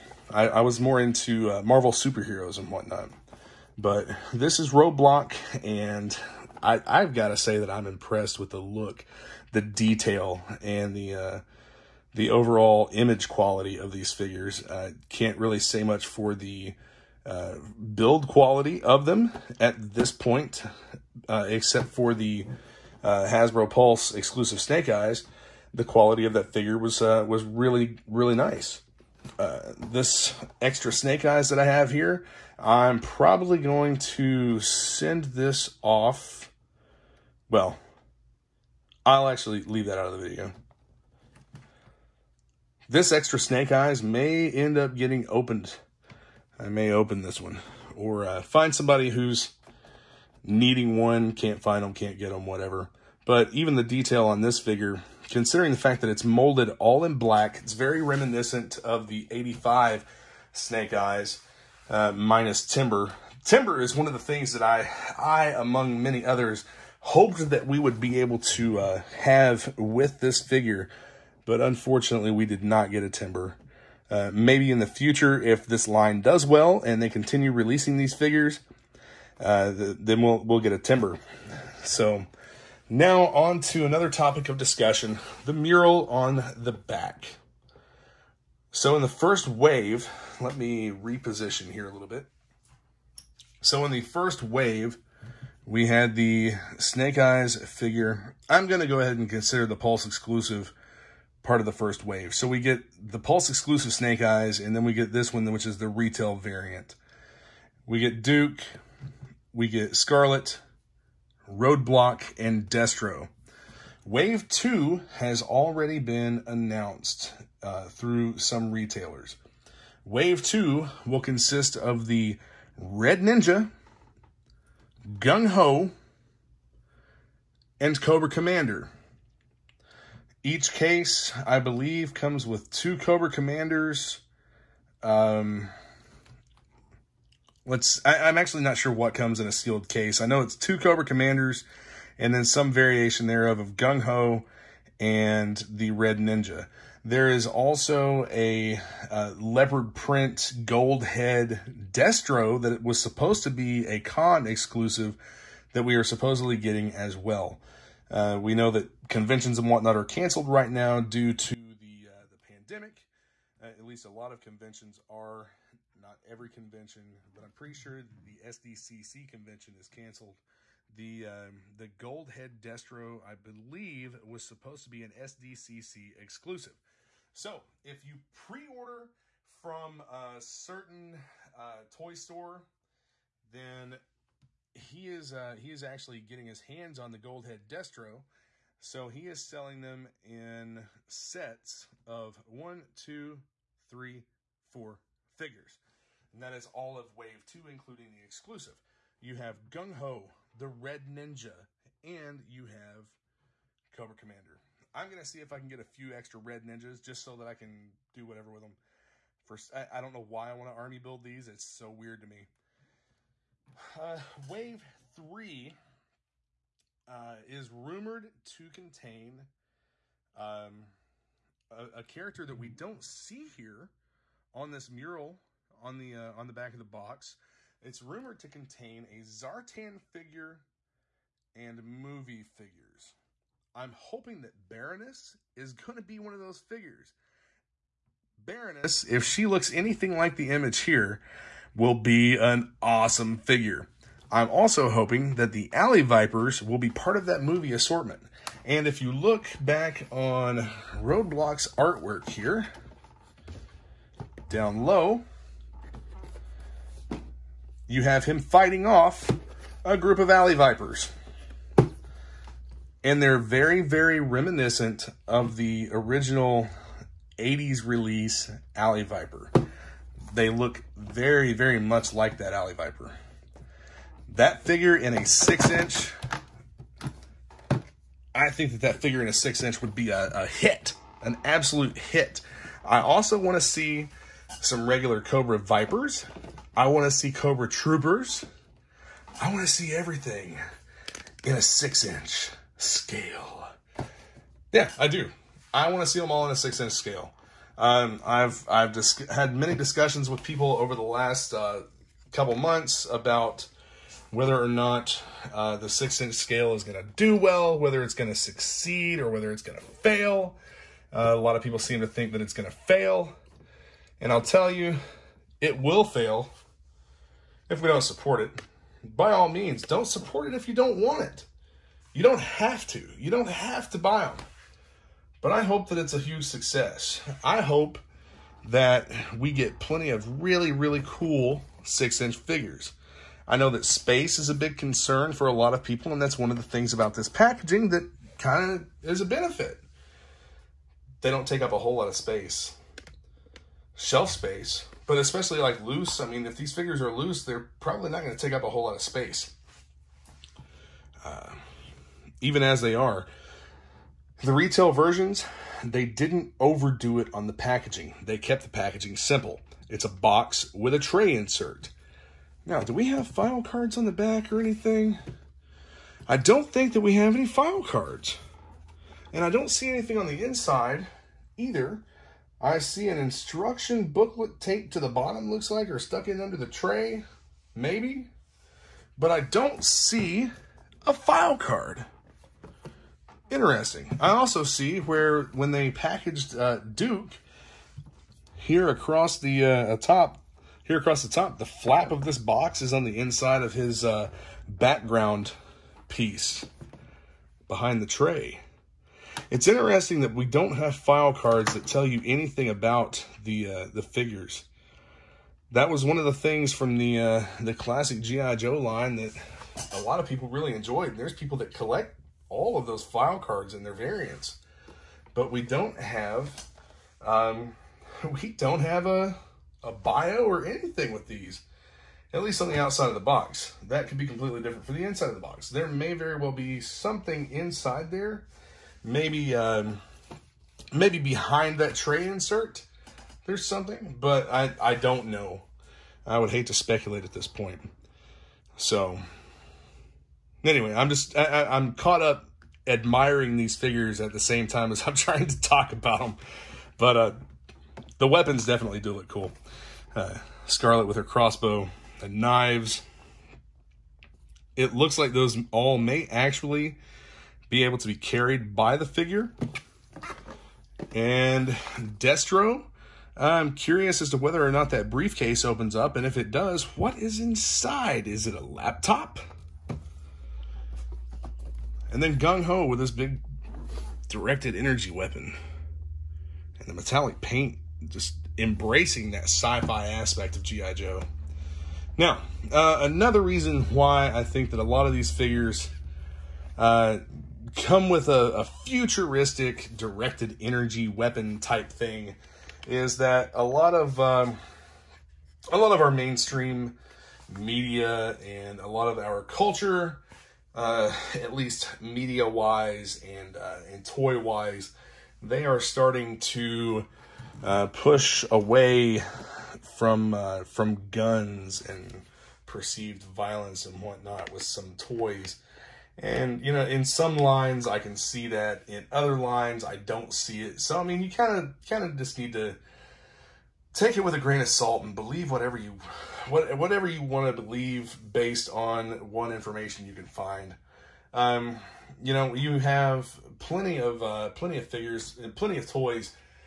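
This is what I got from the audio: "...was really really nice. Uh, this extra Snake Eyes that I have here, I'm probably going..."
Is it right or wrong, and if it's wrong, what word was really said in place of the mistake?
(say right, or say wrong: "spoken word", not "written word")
right.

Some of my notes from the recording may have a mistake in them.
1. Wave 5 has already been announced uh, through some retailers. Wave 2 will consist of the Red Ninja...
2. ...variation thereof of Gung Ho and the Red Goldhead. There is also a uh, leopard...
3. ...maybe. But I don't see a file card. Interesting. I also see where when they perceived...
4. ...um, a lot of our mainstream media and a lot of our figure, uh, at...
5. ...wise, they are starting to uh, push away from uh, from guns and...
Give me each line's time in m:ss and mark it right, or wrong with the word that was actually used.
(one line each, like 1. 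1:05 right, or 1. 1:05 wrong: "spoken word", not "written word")
1. 1:54 wrong: "2", not "5"
2. 2:22 wrong: "Ninja", not "Goldhead"
3. 6:17 wrong: "packaged", not "perceived"
4. 8:14 wrong: "culture", not "figure"
5. 8:24 right.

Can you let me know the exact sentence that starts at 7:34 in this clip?
It looks like those all may actually be able to be carried by the figure.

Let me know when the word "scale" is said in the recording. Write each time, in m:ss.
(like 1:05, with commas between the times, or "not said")
4:52, 4:56, 5:06.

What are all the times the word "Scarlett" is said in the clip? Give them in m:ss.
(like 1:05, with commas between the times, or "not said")
1:49, 7:30.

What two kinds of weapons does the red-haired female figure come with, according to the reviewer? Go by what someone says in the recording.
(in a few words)
crossbow and knives.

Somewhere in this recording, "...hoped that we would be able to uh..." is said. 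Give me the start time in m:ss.
1:06.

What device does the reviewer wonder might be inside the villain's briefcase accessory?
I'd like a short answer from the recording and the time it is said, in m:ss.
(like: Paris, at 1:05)
laptop, at 7:48.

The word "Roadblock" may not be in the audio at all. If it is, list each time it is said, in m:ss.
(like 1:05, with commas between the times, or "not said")
0:04, 1:51, 4:10.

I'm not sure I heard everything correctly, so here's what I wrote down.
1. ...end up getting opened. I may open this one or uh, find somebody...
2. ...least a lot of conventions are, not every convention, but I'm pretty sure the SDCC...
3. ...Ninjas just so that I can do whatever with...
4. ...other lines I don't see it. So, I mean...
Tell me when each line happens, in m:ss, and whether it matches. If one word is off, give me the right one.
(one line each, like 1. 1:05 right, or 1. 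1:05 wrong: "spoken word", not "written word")
1. 0:44 right
2. 2:43 right
3. 3:26 right
4. 8:39 right.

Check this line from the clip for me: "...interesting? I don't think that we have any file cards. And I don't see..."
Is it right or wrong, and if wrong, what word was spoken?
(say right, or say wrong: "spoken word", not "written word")
wrong: "anything", not "interesting".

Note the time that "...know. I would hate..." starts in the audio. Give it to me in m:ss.
7:15.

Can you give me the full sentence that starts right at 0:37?
Well, I'll actually leave that out of the video.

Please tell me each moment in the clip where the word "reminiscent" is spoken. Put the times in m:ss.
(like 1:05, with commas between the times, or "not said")
0:58, 4:24.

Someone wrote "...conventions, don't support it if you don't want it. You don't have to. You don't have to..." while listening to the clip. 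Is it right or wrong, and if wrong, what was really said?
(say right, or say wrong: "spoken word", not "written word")
wrong: "means", not "conventions".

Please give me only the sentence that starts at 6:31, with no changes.
The flap of this box is on the inside of his uh, background piece behind the tray.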